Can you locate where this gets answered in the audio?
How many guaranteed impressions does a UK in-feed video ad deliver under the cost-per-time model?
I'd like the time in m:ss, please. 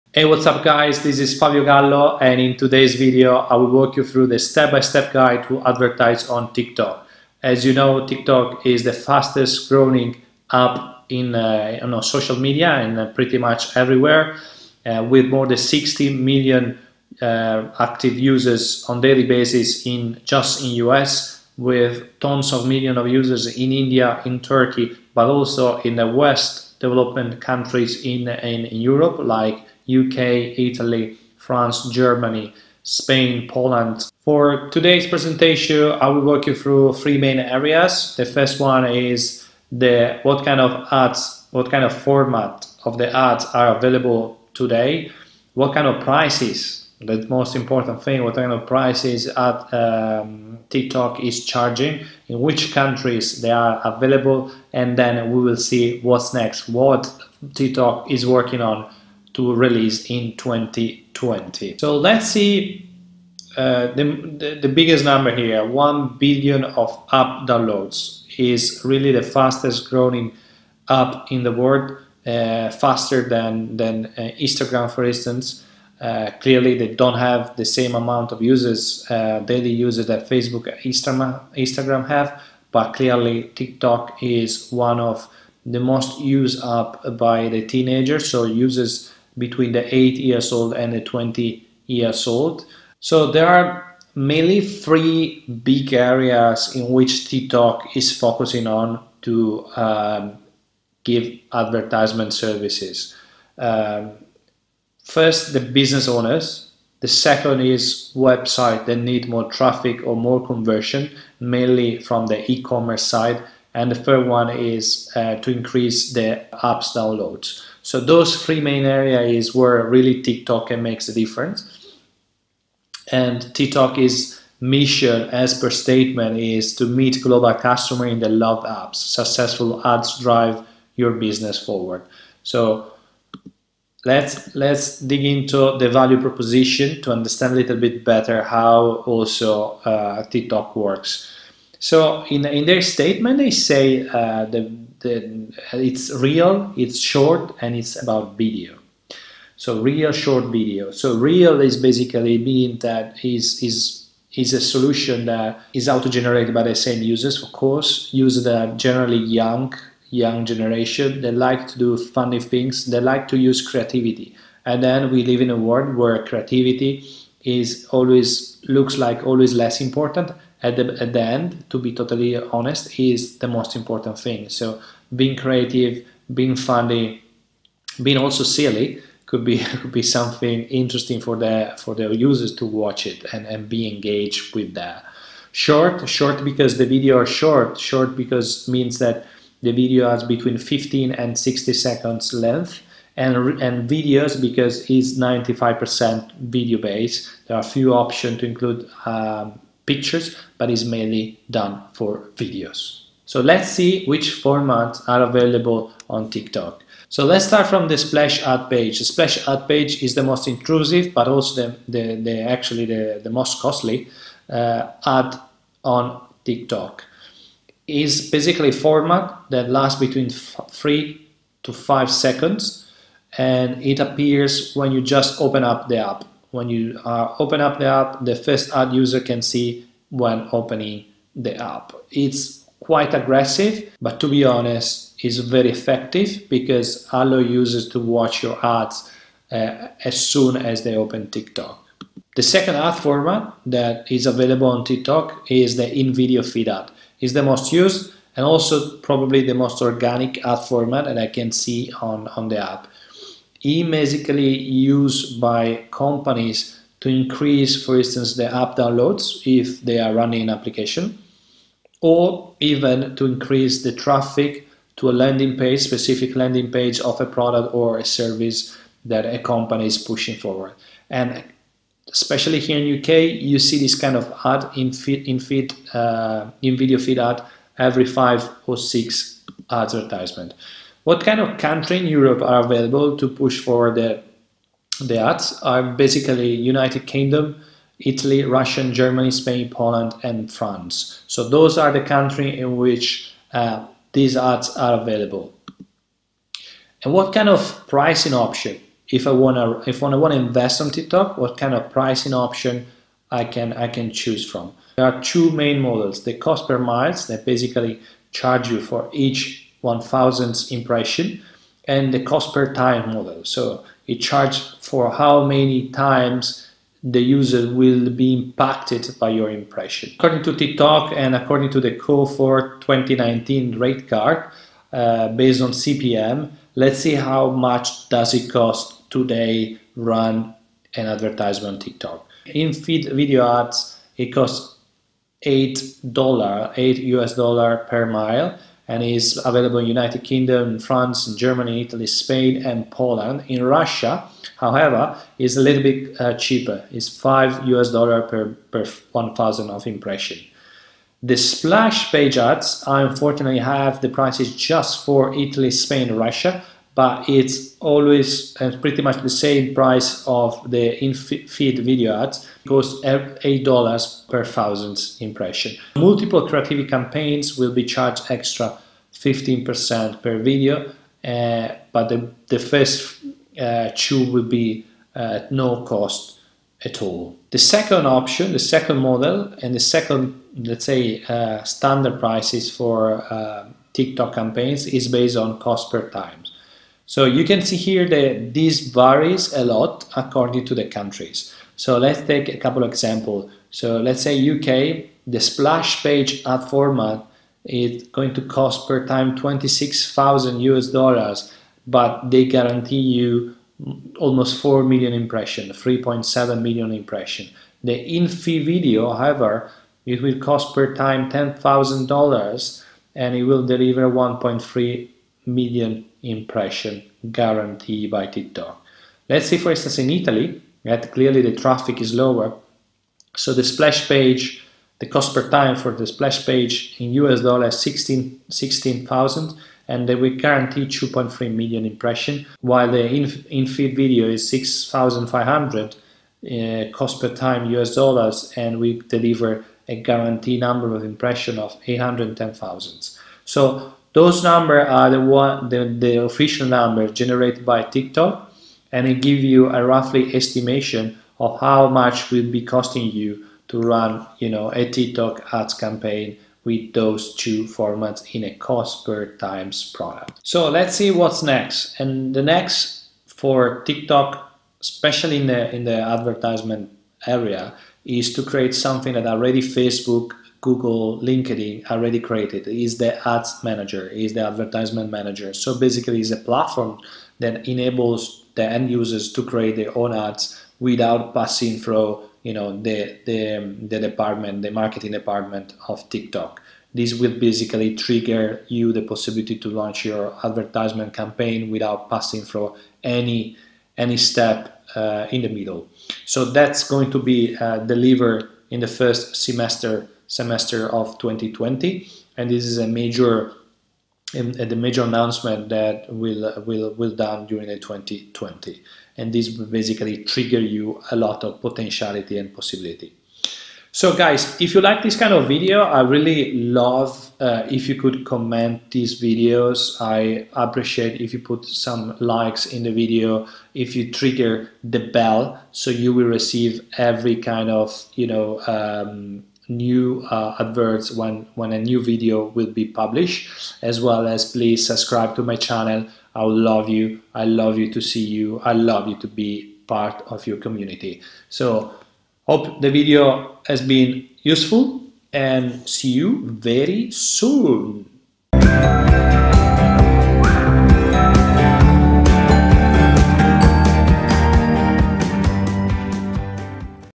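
6:54.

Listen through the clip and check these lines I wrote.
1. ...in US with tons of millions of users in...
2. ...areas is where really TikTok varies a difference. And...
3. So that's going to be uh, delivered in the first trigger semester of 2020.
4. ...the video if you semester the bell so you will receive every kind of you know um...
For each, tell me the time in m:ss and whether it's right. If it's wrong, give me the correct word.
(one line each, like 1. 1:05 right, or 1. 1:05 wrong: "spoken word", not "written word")
1. 0:20 right
2. 1:58 wrong: "makes", not "varies"
3. 8:16 wrong: "semester", not "trigger"
4. 8:42 wrong: "trigger", not "semester".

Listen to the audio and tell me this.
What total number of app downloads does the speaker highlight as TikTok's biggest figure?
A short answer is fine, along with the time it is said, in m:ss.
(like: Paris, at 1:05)
1 billion, at 1:05.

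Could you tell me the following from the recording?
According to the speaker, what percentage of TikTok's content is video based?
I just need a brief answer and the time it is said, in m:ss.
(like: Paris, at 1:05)
95%, at 3:15.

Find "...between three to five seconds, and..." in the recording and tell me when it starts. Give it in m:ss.
3:39.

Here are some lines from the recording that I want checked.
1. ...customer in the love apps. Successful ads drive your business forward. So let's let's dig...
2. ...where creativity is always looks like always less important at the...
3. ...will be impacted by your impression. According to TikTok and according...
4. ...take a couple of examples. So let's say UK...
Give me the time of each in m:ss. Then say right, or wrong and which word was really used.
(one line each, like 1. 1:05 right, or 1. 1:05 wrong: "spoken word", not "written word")
1. 2:07 right
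2. 2:45 right
3. 5:17 right
4. 6:32 right.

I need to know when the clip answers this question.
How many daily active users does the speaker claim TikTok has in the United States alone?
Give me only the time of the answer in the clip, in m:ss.
0:15.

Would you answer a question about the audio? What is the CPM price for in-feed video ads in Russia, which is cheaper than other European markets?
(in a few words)
$5.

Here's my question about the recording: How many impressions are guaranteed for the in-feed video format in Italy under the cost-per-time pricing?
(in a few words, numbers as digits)
810,000.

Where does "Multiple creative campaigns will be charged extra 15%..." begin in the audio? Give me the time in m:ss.
6:05.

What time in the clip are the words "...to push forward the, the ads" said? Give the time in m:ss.
4:43.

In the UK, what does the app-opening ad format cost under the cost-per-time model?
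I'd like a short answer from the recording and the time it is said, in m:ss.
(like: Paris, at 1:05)
$26,000, at 6:39.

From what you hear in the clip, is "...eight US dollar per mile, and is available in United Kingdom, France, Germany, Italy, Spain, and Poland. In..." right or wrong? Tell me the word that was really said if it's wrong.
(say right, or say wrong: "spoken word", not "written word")
right.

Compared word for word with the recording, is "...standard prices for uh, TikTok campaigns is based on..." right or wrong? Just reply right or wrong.
right.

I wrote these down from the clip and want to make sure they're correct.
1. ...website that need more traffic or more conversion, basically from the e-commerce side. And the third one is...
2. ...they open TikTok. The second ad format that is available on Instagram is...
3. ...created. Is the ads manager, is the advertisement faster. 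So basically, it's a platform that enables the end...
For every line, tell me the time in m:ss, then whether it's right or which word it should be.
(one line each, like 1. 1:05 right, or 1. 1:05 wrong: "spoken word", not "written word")
1. 1:48 wrong: "mainly", not "basically"
2. 4:00 wrong: "TikTok", not "Instagram"
3. 7:52 wrong: "manager", not "faster".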